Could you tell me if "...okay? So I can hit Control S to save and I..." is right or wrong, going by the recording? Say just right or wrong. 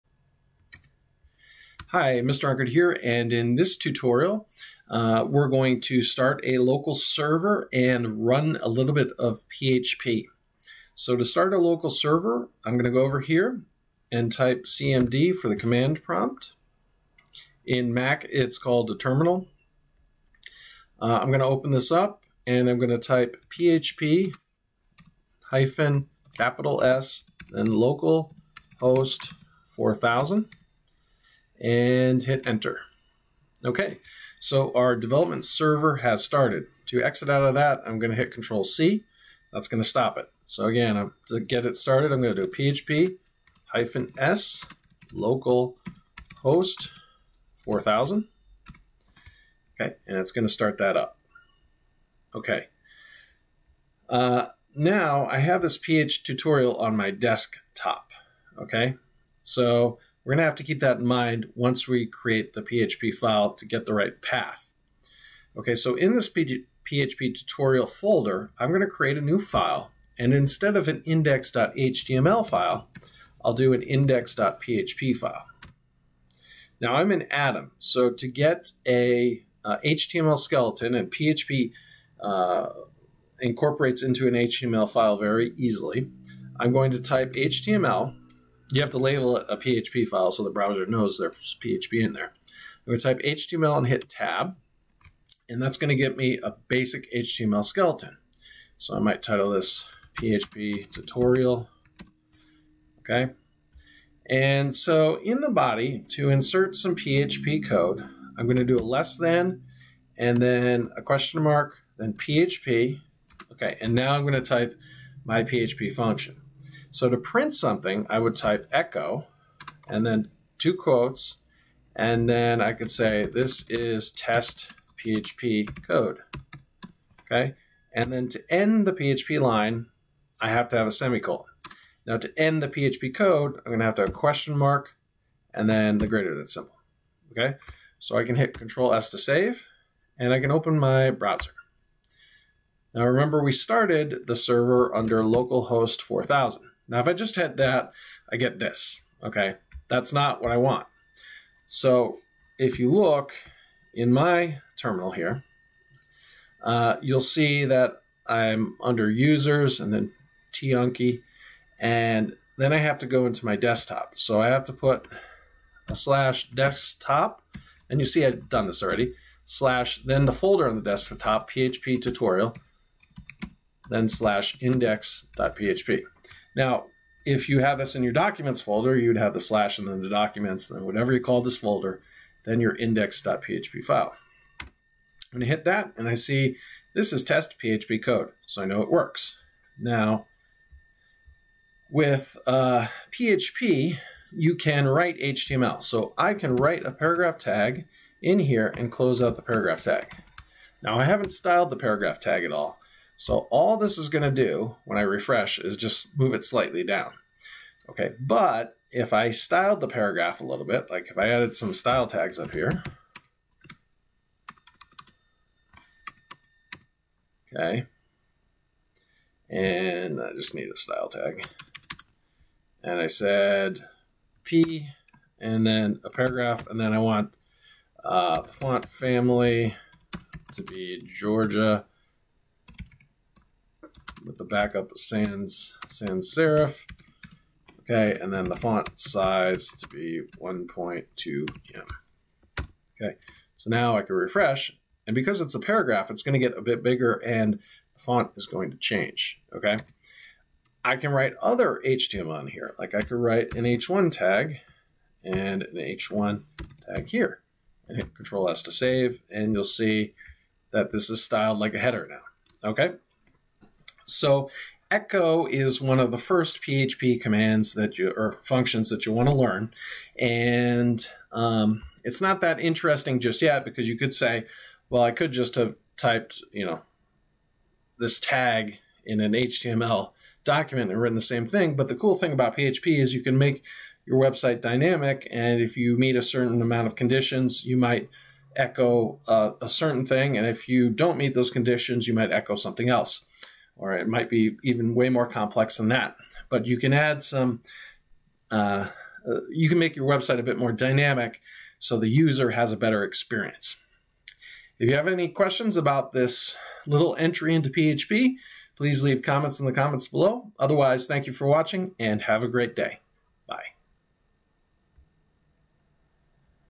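right.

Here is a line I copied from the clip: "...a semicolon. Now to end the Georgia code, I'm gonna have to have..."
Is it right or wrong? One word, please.
wrong.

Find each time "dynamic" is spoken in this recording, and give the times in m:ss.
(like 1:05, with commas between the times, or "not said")
4:44, 5:00.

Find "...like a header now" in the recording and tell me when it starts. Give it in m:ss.
4:21.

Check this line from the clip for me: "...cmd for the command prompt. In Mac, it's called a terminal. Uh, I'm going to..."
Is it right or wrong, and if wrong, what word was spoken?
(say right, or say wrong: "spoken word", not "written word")
right.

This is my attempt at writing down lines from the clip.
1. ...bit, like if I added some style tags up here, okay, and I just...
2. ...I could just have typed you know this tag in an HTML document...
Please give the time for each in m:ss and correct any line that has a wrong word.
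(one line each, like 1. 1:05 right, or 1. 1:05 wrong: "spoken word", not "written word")
1. 3:30 right
2. 4:35 right.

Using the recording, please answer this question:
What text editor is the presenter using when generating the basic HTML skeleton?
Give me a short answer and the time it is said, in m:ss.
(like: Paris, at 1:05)
Atom, at 1:17.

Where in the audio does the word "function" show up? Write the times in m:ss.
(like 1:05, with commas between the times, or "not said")
1:55, 4:28.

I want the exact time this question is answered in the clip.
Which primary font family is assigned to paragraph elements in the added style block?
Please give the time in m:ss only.
3:51.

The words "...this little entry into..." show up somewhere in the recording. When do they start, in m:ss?
5:06.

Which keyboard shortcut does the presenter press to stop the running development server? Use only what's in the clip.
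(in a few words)
Control C.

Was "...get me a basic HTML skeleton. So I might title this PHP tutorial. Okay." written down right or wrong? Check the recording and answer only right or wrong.
right.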